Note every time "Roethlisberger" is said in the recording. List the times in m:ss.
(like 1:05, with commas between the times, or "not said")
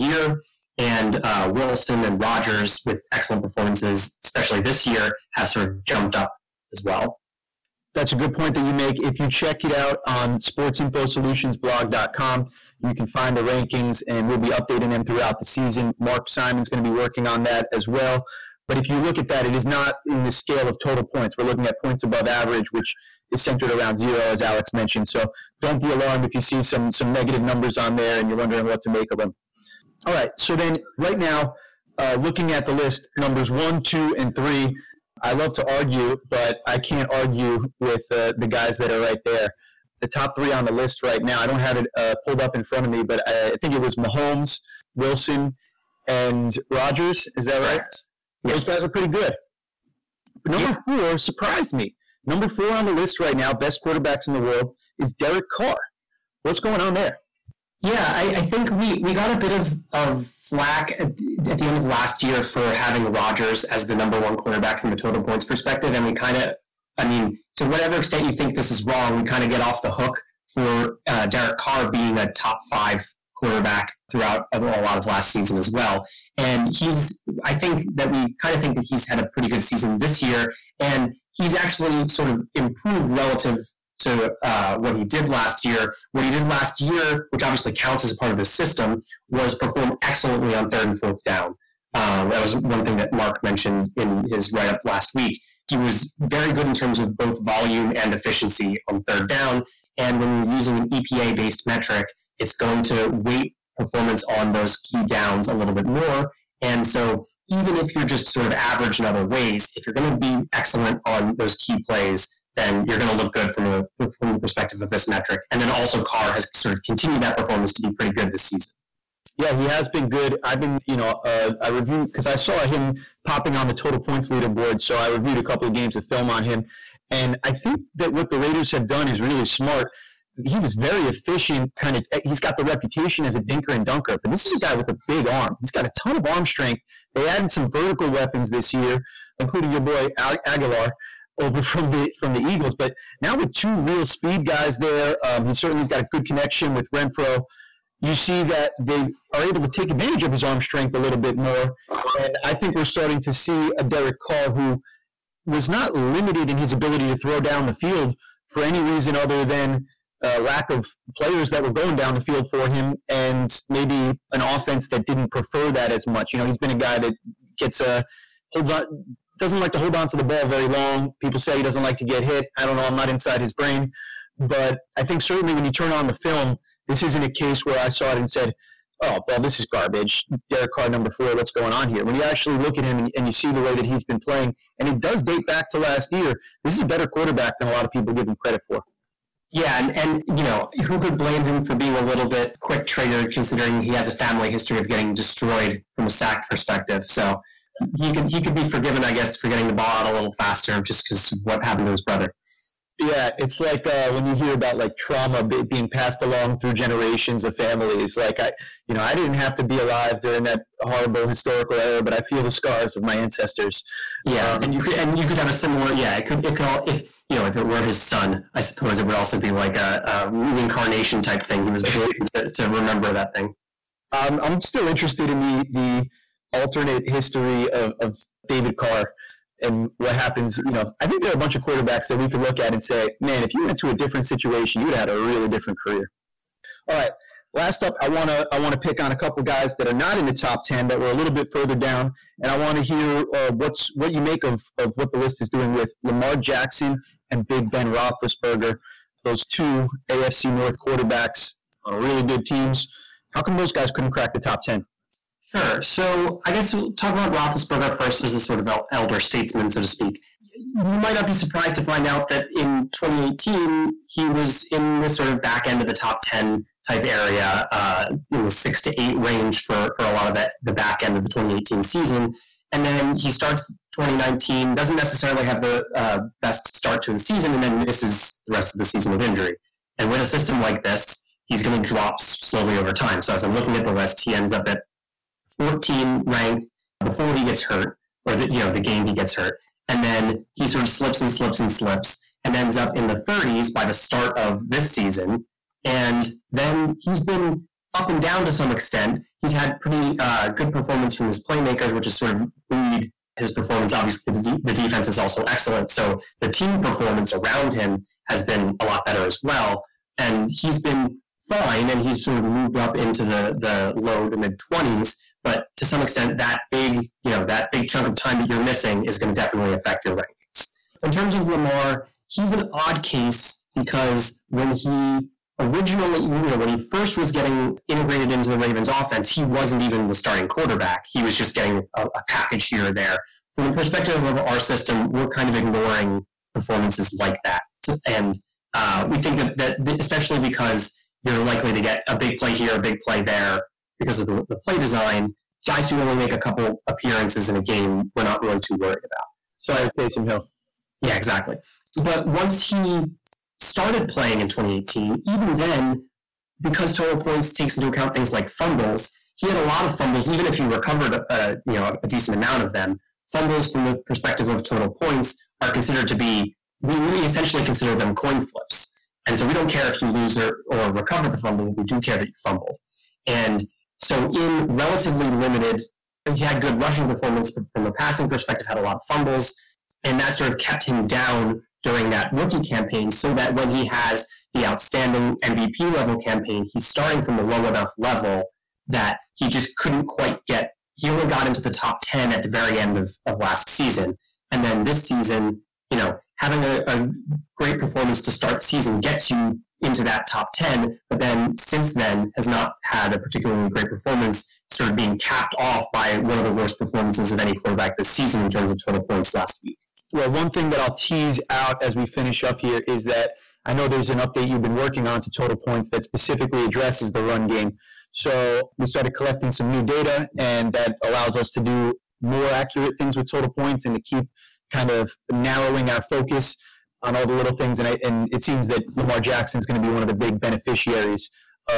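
4:07, 4:17.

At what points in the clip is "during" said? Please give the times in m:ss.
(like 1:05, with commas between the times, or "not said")
3:30, 6:21.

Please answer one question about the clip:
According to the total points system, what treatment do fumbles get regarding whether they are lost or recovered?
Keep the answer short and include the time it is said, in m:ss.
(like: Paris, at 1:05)
Coin flips, at 6:08.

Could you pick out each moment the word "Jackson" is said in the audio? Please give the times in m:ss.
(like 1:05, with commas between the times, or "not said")
4:06, 7:09.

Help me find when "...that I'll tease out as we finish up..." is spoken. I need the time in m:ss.
6:50.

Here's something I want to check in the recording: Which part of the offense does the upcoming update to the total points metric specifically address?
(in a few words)
The run game.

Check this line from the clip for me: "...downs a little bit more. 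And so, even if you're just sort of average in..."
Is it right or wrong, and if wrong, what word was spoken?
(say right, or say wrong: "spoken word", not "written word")
right.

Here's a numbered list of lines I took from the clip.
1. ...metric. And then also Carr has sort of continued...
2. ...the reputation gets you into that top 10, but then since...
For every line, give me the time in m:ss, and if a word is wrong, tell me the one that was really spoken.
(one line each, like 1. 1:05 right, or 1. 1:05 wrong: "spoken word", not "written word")
1. 1:55 right
2. 6:38 wrong: "season", not "reputation".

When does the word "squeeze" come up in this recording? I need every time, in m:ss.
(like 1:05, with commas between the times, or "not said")
not said.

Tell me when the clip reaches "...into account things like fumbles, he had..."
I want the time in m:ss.
5:57.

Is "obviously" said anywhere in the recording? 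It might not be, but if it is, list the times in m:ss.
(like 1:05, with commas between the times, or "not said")
1:27, 5:03.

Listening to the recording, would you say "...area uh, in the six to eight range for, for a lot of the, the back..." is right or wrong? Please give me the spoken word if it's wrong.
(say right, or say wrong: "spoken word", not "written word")
right.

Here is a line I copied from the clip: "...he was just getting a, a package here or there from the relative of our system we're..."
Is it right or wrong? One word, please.
wrong.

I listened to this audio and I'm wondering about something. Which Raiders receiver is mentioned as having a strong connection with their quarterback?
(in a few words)
Renfrow.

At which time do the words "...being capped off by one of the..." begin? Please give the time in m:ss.
6:44.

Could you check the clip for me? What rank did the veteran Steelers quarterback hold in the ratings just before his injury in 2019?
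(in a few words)
14.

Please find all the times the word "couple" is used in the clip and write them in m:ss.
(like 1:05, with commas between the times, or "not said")
2:05, 3:59, 5:46.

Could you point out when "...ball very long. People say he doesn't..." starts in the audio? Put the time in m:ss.
2:50.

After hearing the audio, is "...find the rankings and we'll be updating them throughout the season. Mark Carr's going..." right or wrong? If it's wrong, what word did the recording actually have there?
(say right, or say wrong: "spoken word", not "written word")
wrong: "Simon", not "Carr".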